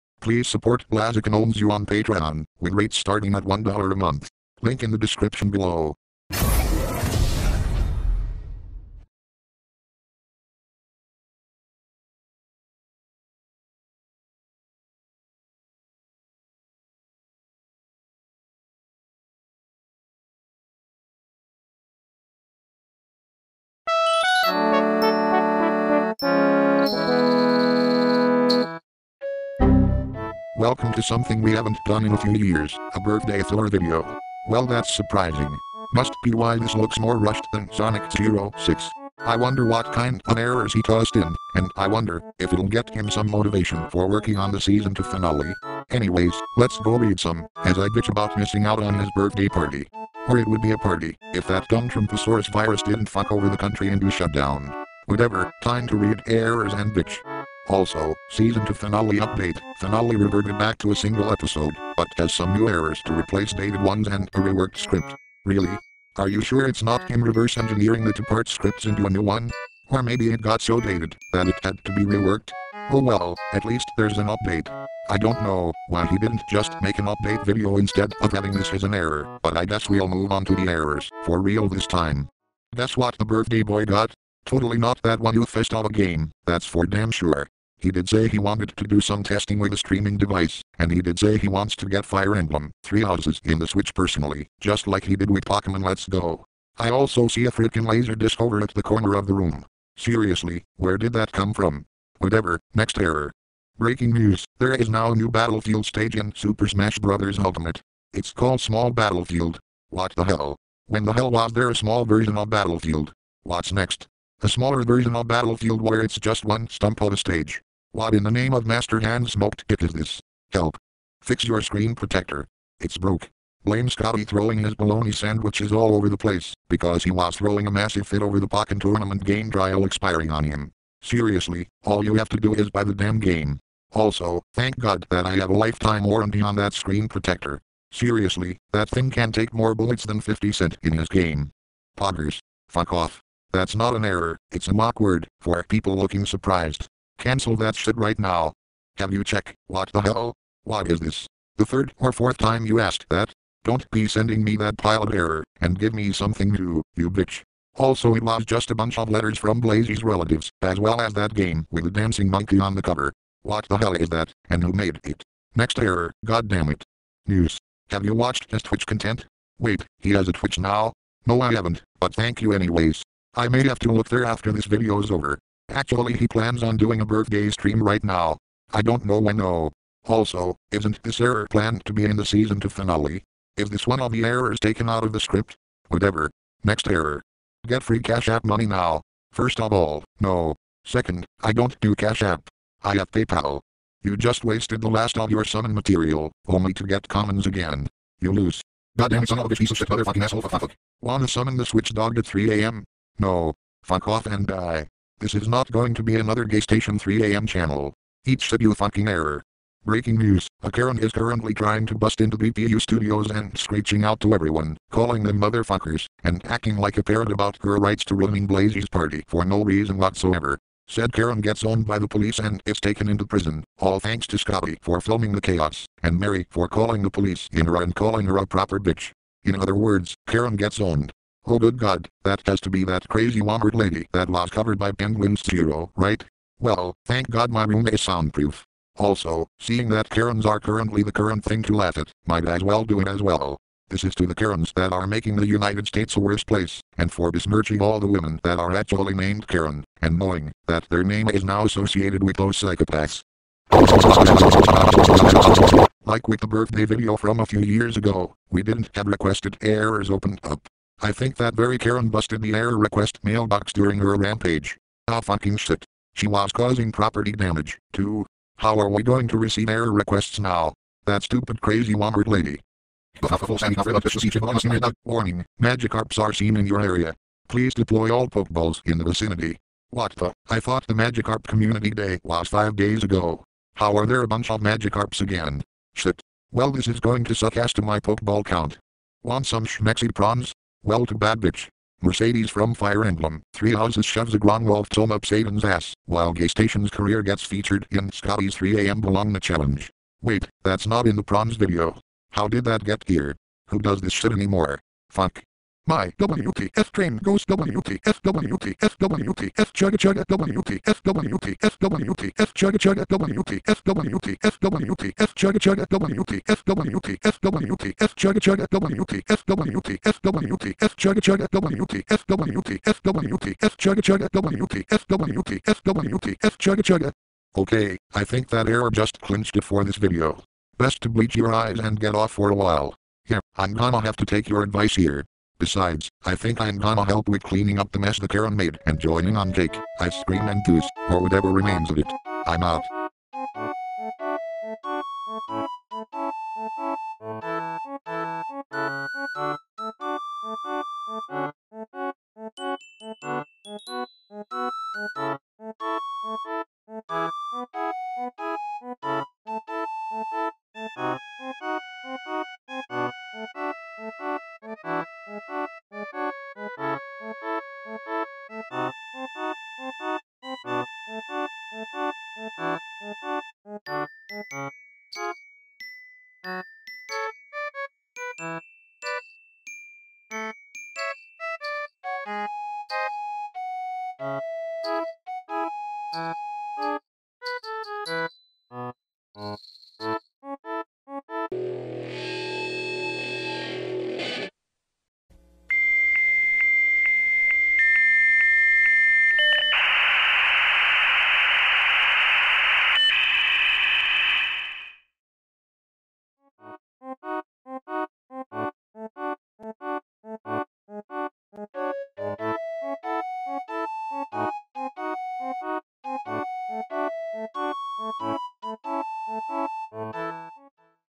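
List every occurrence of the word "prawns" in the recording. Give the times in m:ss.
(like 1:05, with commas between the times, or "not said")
4:50, 5:01.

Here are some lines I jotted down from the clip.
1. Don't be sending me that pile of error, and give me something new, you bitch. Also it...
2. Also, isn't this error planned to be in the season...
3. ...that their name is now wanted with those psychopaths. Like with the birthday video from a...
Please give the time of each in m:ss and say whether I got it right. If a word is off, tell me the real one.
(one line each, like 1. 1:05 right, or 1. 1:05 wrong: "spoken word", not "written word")
1. 2:33 right
2. 3:00 right
3. 4:10 wrong: "associated", not "wanted".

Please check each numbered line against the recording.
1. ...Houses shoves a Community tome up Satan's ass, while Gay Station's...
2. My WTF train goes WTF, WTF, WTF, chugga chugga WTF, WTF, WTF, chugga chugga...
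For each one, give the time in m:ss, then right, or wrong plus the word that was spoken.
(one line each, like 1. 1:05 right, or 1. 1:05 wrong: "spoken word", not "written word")
1. 4:53 wrong: "Gronwolf", not "Community"
2. 5:05 right.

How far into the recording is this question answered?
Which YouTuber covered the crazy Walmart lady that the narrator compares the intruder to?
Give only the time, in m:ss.
3:54.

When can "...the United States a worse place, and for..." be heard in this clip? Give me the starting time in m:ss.
4:05.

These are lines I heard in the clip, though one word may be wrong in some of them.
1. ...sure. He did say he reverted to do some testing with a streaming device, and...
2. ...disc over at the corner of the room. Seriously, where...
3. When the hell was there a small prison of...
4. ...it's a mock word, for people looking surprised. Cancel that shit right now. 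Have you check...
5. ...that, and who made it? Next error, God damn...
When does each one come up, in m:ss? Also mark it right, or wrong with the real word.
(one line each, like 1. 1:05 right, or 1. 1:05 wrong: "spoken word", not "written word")
1. 1:27 wrong: "wanted", not "reverted"
2. 1:38 right
3. 1:50 wrong: "version", not "prison"
4. 2:24 right
5. 2:44 right.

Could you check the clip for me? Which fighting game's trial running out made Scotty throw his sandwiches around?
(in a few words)
Pokkén Tournament.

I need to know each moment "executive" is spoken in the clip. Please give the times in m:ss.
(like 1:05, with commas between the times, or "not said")
not said.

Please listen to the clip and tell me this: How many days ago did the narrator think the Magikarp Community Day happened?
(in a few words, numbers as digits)
5.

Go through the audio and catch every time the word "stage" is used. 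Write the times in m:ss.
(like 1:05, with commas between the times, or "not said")
1:45, 1:57.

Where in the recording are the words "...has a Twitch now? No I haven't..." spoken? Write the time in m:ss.
2:50.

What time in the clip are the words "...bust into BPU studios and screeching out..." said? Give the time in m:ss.
3:31.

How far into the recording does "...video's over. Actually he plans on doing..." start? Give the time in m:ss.
2:54.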